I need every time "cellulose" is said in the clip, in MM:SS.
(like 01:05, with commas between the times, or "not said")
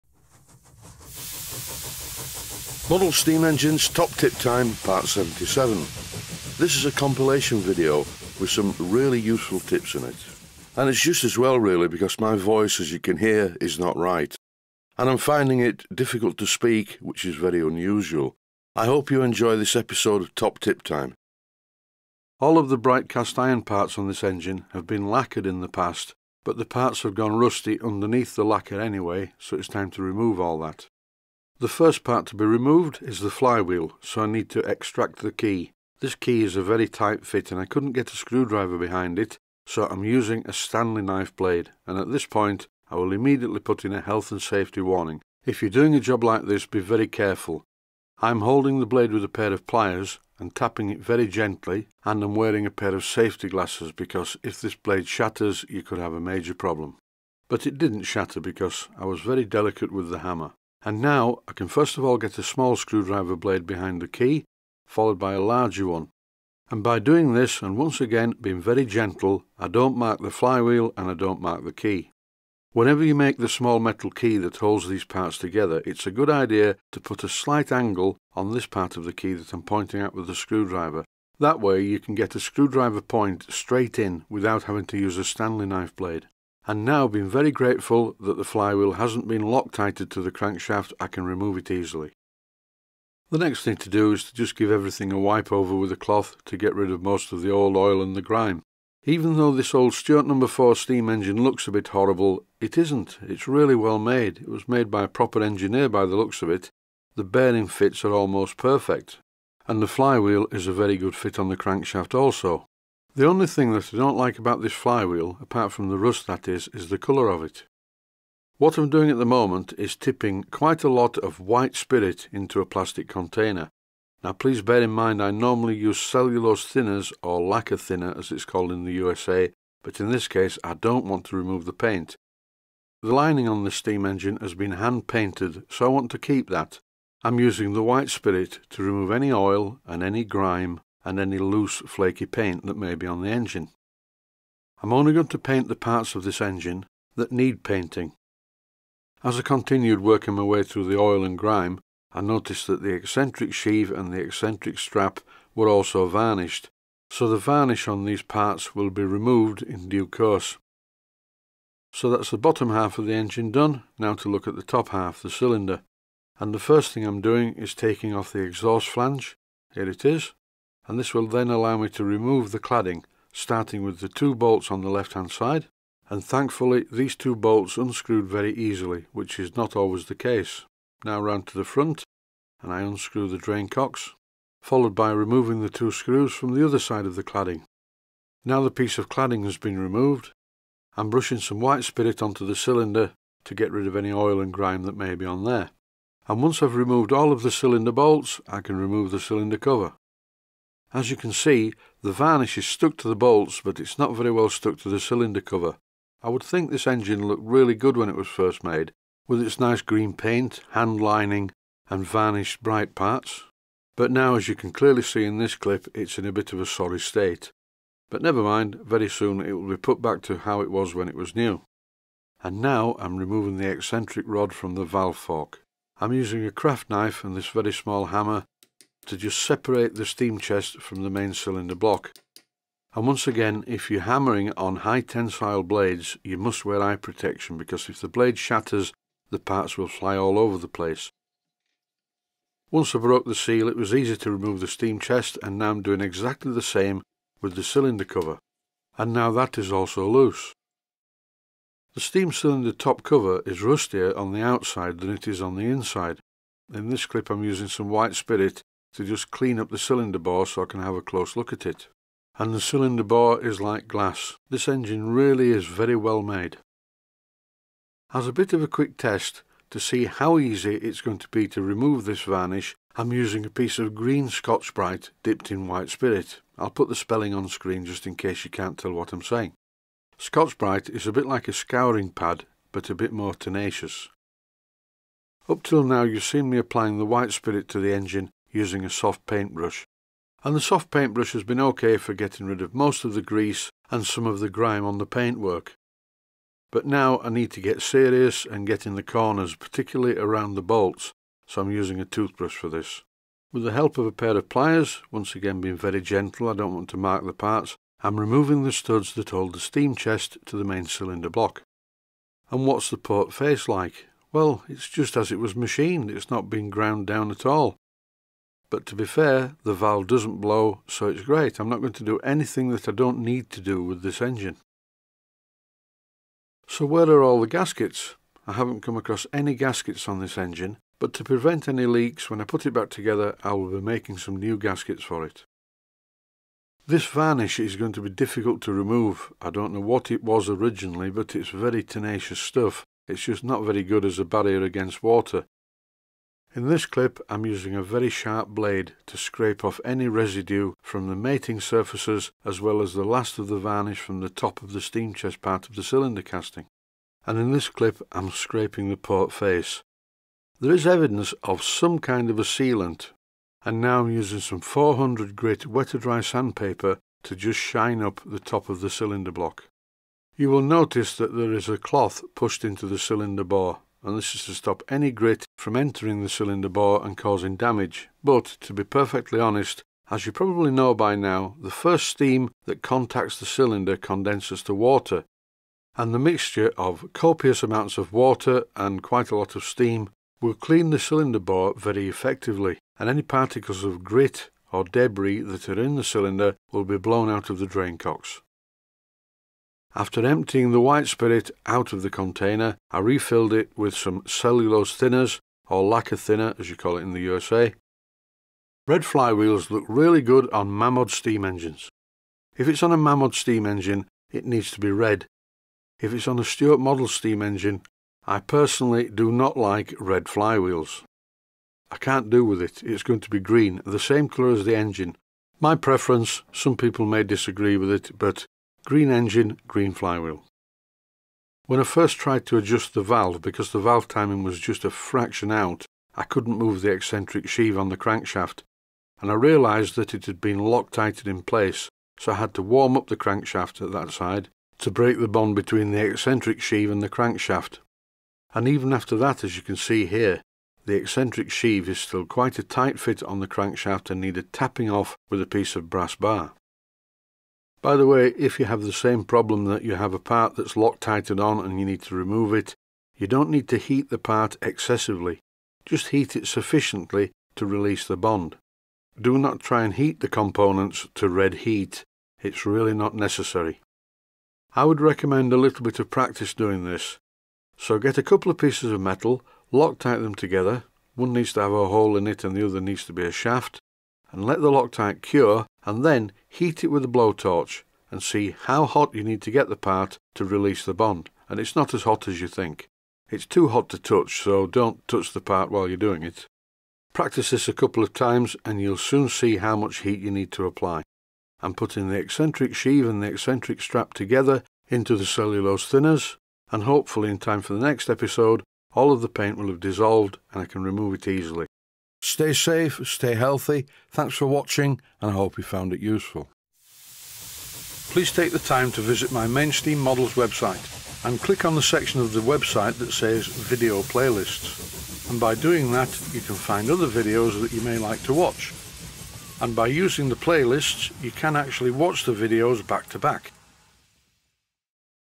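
02:05, 06:44, 08:25.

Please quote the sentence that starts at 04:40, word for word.
Scotch Brite is a bit like a scouring pad, but a bit more tenacious.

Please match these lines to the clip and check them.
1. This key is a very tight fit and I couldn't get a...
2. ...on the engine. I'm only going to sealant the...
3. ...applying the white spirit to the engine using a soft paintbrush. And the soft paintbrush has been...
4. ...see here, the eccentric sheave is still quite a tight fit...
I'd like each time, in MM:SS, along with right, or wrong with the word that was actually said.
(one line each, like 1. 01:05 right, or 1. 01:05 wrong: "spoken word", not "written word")
1. 00:35 right
2. 02:23 wrong: "paint", not "sealant"
3. 04:46 right
4. 07:29 right.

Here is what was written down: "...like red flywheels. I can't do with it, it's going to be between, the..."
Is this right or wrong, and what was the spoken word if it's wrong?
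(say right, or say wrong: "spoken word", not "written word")
wrong: "green", not "between".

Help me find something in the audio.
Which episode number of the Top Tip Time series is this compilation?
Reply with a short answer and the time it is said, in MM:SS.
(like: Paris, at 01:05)
77, at 00:04.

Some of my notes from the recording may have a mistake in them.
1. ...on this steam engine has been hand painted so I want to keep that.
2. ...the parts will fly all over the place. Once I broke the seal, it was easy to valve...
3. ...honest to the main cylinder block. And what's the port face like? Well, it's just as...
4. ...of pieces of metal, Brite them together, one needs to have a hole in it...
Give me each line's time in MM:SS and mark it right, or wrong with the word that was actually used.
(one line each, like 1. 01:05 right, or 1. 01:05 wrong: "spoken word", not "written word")
1. 02:13 right
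2. 03:59 wrong: "remove", not "valve"
3. 05:09 wrong: "chest", not "honest"
4. 07:58 wrong: "Loctite", not "Brite".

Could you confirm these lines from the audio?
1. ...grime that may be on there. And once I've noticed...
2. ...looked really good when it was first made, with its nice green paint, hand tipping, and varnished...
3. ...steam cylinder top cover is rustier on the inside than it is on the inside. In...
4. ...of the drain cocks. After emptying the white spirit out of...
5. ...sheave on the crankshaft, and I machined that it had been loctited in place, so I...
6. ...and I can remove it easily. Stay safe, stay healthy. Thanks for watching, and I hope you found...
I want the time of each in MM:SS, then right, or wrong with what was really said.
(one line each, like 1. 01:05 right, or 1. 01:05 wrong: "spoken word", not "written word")
1. 03:14 wrong: "removed", not "noticed"
2. 03:27 wrong: "lining", not "tipping"
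3. 04:12 wrong: "outside", not "inside"
4. 06:37 right
5. 07:17 wrong: "realised", not "machined"
6. 08:30 right.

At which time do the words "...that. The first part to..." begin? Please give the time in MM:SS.
00:30.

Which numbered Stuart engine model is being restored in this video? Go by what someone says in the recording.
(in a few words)
No. 4.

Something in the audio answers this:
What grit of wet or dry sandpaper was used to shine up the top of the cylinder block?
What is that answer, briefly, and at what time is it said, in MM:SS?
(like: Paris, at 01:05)
400, at 06:04.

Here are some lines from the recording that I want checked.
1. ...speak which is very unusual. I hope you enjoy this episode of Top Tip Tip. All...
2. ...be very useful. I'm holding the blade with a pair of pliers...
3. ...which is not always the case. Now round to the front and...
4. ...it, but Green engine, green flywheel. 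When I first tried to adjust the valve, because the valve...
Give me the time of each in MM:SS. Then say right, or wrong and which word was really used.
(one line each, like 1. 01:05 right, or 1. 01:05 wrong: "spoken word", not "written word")
1. 00:16 wrong: "Time", not "Tip"
2. 00:46 wrong: "careful", not "useful"
3. 02:59 right
4. 07:07 right.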